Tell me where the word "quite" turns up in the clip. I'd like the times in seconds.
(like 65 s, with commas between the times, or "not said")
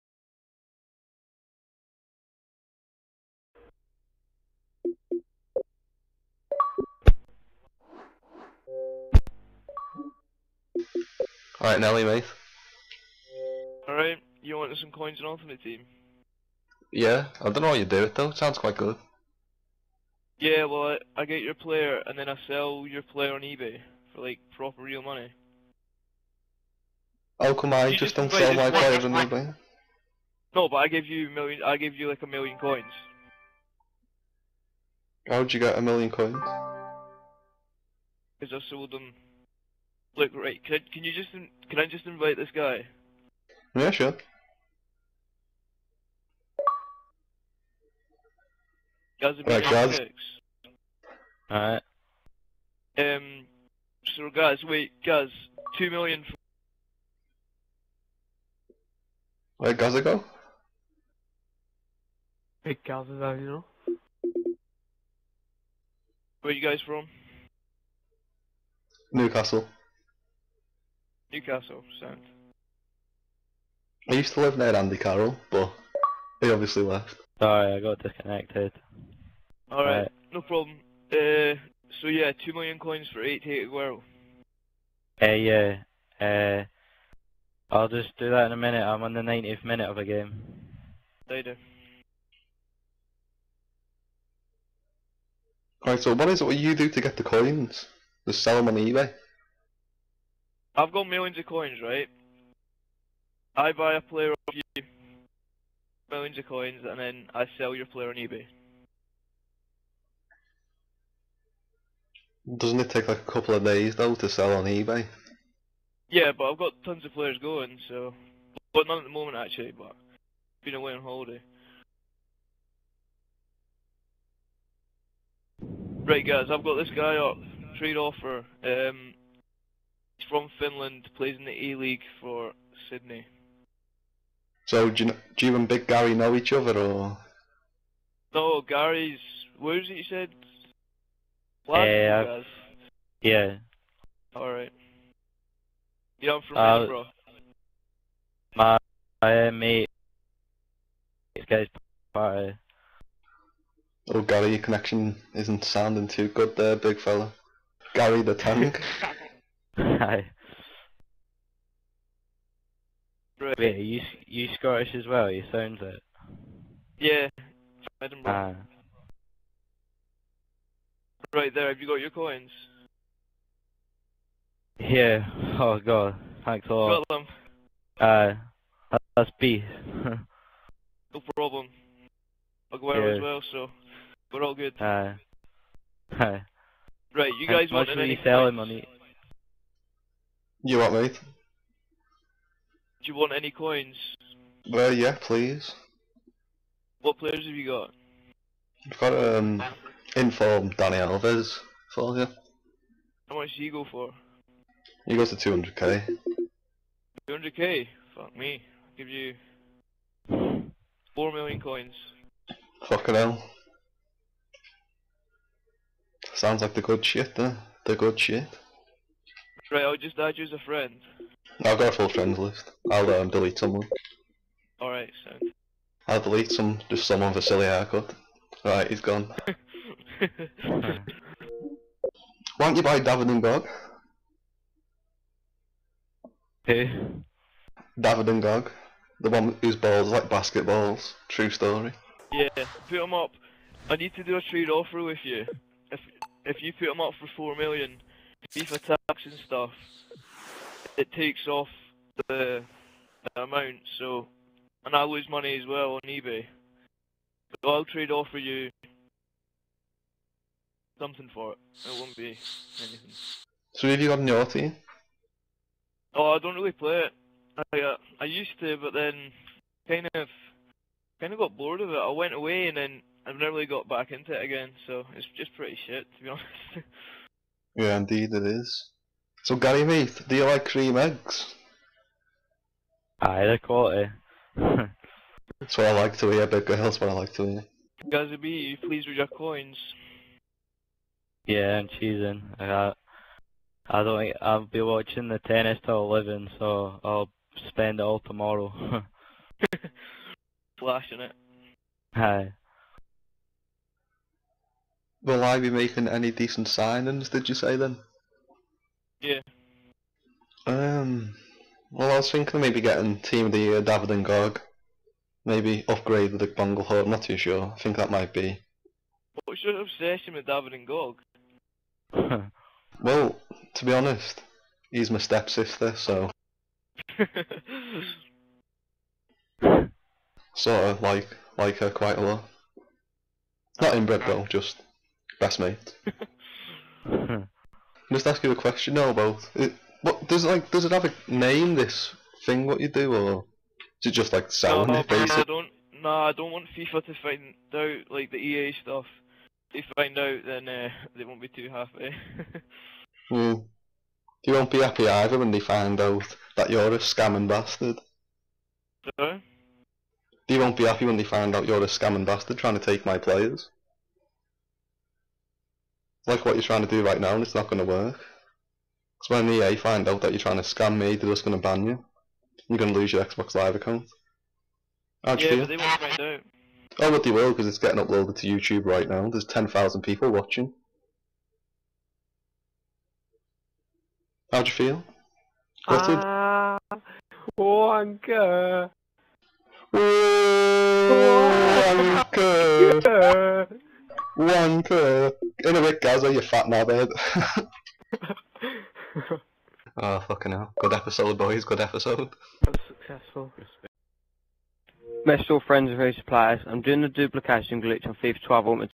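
18 s, 331 s.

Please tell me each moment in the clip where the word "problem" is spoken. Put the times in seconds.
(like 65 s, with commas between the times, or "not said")
80 s, 181 s.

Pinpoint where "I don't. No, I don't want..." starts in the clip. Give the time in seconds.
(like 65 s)
345 s.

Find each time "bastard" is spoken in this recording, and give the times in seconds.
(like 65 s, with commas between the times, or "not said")
357 s, 362 s.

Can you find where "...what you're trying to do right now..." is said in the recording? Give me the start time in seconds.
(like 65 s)
366 s.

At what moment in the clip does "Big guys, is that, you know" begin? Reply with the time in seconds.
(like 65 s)
62 s.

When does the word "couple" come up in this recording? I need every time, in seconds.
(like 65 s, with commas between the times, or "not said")
113 s.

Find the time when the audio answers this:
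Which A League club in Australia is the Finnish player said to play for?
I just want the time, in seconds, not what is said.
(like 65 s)
132 s.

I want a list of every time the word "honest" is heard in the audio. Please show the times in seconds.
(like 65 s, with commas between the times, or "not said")
276 s, 323 s.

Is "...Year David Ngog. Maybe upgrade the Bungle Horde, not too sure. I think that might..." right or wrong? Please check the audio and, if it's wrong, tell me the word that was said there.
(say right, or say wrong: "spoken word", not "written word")
right.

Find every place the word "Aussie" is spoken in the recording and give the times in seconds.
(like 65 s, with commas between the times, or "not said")
264 s.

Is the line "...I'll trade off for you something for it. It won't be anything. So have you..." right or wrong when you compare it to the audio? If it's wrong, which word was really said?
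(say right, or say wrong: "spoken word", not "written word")
right.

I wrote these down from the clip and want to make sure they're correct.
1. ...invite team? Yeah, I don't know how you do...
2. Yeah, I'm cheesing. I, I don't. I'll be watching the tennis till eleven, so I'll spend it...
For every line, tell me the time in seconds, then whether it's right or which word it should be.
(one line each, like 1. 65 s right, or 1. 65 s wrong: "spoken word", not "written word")
1. 15 s wrong: "ultimate", not "invite"
2. 291 s right.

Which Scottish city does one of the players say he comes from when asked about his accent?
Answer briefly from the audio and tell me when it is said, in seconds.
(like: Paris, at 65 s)
Edinburgh, at 168 s.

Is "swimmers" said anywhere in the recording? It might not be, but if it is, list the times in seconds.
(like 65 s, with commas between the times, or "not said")
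not said.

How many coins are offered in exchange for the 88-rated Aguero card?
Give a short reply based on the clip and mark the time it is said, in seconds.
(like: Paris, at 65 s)
2 million, at 82 s.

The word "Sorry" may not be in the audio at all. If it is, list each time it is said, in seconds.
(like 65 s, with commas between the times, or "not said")
77 s, 359 s.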